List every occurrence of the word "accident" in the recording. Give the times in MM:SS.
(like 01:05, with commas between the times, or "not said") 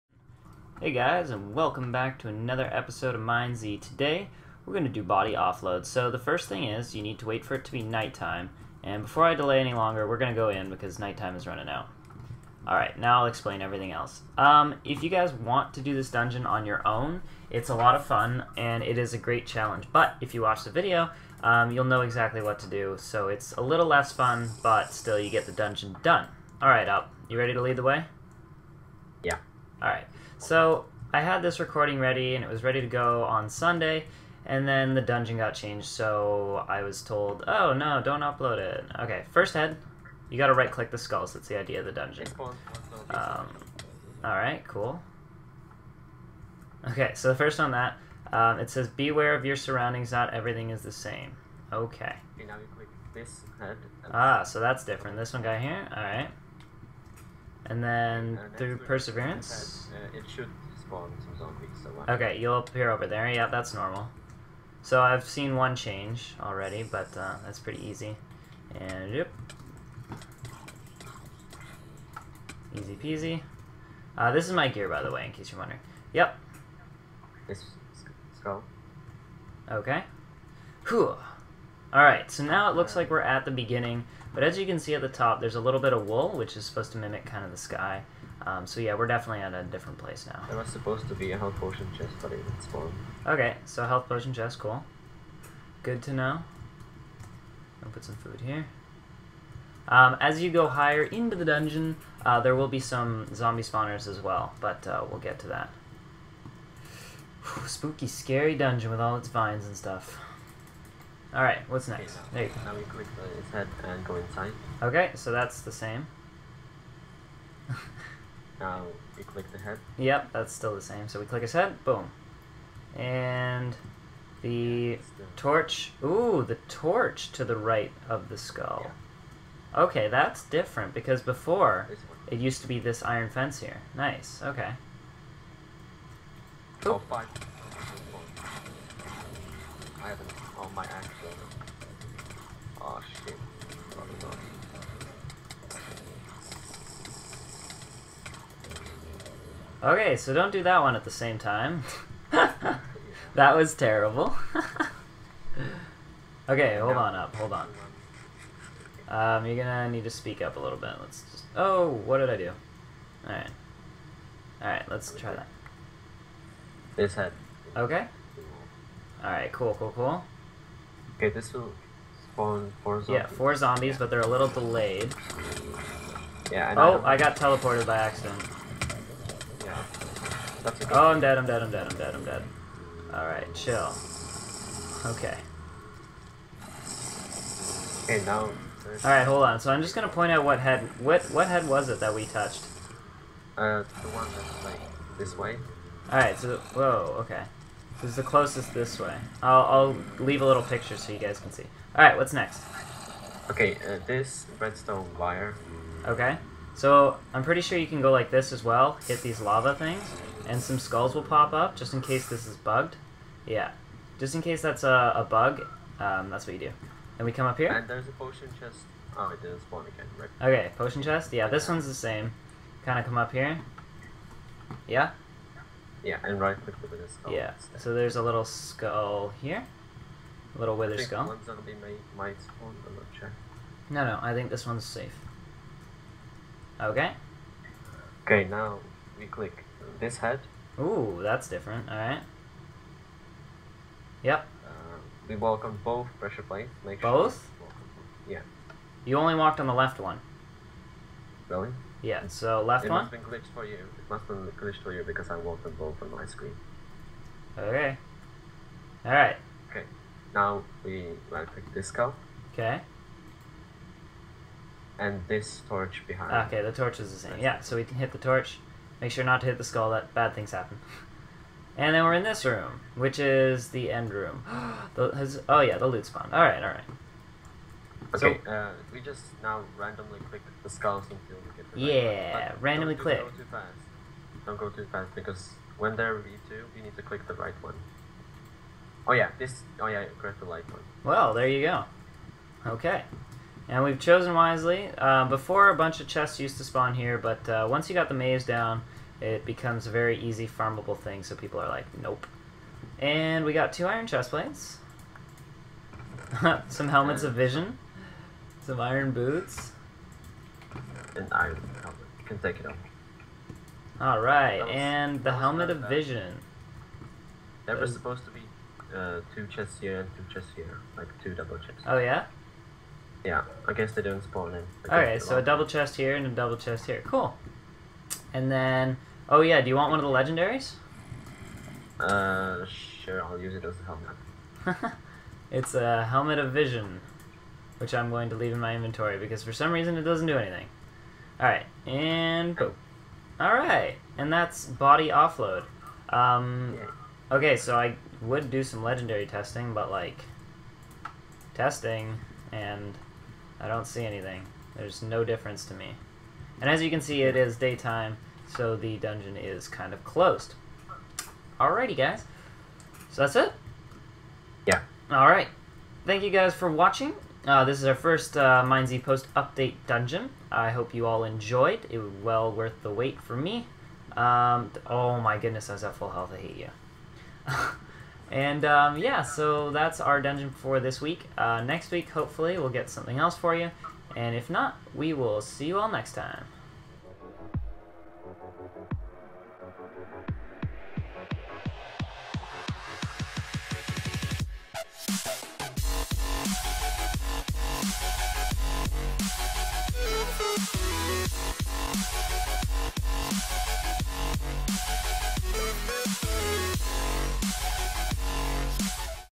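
02:20, 02:57.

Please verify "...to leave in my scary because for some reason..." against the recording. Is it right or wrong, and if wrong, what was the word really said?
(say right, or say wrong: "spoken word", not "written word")
wrong: "inventory", not "scary".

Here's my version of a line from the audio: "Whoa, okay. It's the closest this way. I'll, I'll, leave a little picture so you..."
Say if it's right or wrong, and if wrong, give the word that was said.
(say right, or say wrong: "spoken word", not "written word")
right.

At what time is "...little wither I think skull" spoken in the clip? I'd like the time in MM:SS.
03:50.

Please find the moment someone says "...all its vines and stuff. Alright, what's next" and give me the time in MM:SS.
01:49.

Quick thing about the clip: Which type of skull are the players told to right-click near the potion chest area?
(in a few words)
Wither skull.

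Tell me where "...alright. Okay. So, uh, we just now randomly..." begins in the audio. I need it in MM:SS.
04:36.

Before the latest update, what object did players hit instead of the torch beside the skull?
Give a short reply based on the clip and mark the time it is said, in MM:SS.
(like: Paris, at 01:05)
Iron fence, at 02:13.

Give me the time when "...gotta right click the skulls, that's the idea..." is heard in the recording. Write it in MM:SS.
00:40.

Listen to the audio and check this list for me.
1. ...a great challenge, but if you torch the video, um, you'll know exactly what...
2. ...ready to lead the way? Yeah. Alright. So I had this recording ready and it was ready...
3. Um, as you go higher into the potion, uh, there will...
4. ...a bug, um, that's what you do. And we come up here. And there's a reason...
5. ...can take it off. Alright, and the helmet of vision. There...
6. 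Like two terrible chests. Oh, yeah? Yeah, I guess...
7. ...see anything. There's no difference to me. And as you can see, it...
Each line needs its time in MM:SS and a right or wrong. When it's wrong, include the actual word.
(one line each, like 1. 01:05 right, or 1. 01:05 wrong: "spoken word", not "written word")
1. 00:19 wrong: "watch", not "torch"
2. 00:27 right
3. 01:39 wrong: "dungeon", not "potion"
4. 03:35 wrong: "potion", not "reason"
5. 05:12 right
6. 05:20 wrong: "double", not "terrible"
7. 05:53 right.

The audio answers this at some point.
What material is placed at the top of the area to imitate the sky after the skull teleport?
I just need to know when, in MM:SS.
01:26.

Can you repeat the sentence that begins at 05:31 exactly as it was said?
Uh, sure, I'll use it as a helmet.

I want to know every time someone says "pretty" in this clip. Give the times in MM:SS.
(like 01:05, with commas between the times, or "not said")
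01:07, 03:27.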